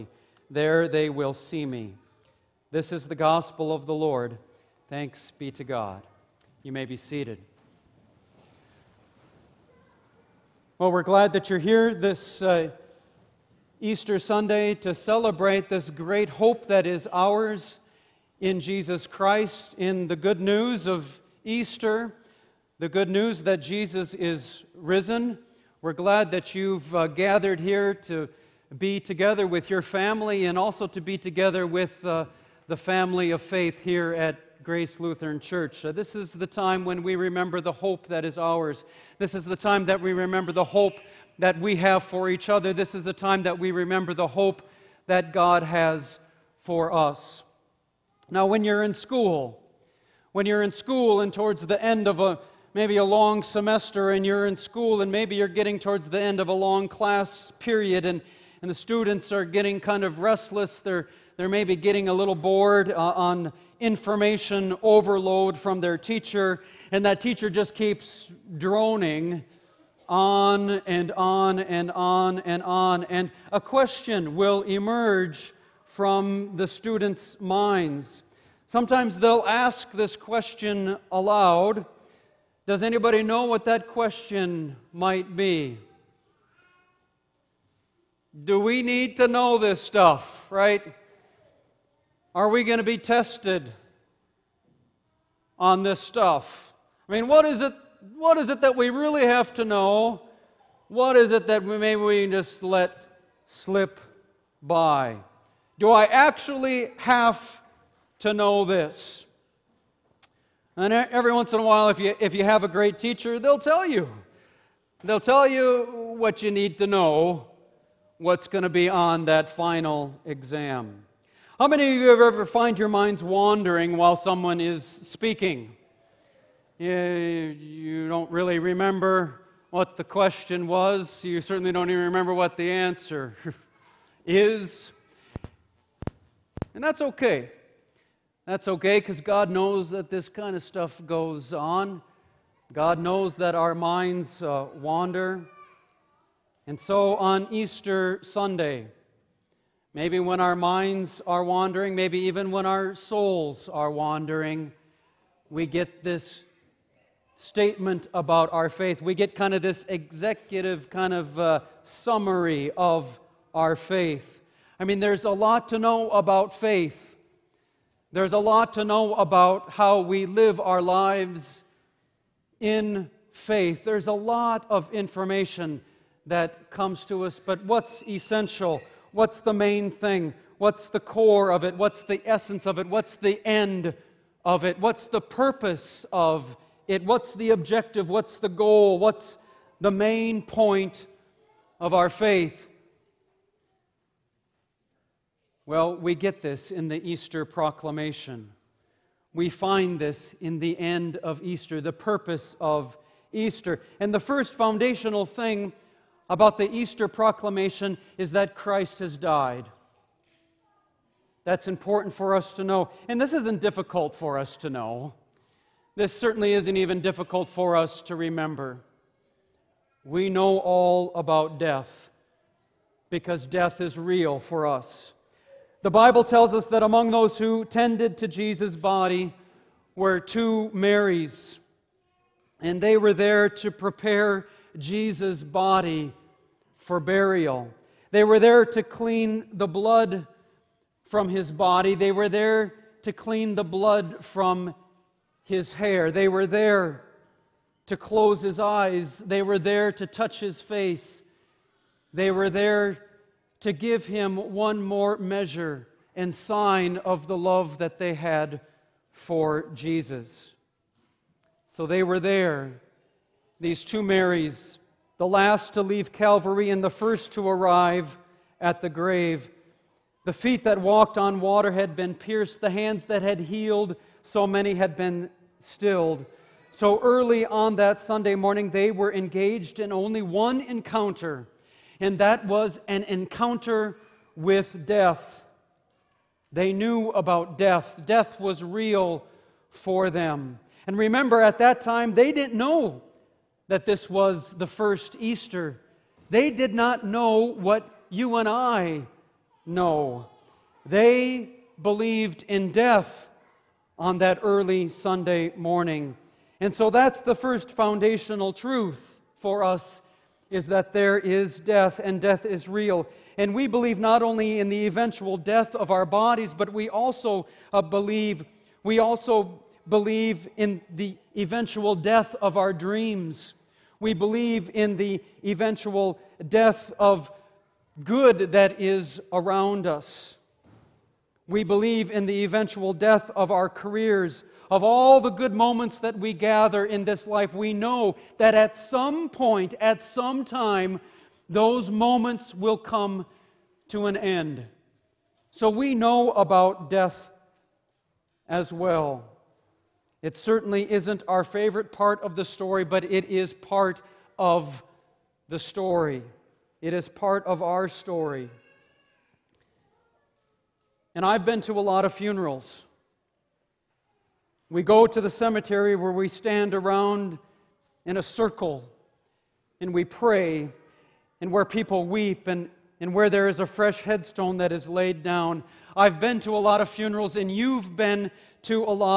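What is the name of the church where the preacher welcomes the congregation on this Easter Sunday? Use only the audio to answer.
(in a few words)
Grace Lutheran Church.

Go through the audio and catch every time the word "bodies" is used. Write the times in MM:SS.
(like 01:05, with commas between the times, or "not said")
05:16.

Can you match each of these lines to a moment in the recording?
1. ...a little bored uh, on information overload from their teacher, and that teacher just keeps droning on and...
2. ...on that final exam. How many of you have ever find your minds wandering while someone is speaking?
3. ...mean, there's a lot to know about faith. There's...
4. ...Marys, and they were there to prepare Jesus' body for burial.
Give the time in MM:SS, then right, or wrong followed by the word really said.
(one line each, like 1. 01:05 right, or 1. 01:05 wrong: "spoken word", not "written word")
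1. 01:02 right
2. 01:58 right
3. 02:44 right
4. 03:50 right.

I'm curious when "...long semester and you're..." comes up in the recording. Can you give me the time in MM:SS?
00:53.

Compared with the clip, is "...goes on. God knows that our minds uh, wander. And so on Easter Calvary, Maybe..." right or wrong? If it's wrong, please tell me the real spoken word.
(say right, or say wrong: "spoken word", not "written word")
wrong: "Sunday", not "Calvary".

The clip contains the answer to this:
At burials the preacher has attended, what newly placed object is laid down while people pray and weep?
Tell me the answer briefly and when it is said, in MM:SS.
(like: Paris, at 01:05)
fresh headstone, at 06:13.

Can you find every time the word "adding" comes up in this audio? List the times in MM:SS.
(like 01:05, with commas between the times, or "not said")
not said.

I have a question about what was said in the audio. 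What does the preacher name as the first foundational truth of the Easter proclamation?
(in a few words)
Christ has died.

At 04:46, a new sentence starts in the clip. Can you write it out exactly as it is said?
They knew about death, death was real for them.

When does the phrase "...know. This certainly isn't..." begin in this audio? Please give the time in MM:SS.
03:34.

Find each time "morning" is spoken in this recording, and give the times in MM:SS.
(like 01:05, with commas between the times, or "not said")
04:38, 05:05.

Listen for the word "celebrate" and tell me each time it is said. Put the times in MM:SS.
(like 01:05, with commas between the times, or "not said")
00:14.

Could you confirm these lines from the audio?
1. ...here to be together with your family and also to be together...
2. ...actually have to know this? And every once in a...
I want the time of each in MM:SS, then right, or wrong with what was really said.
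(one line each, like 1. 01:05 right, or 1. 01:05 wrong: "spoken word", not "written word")
1. 00:27 right
2. 01:46 right.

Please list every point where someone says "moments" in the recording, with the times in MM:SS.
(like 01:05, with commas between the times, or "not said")
05:35, 05:41.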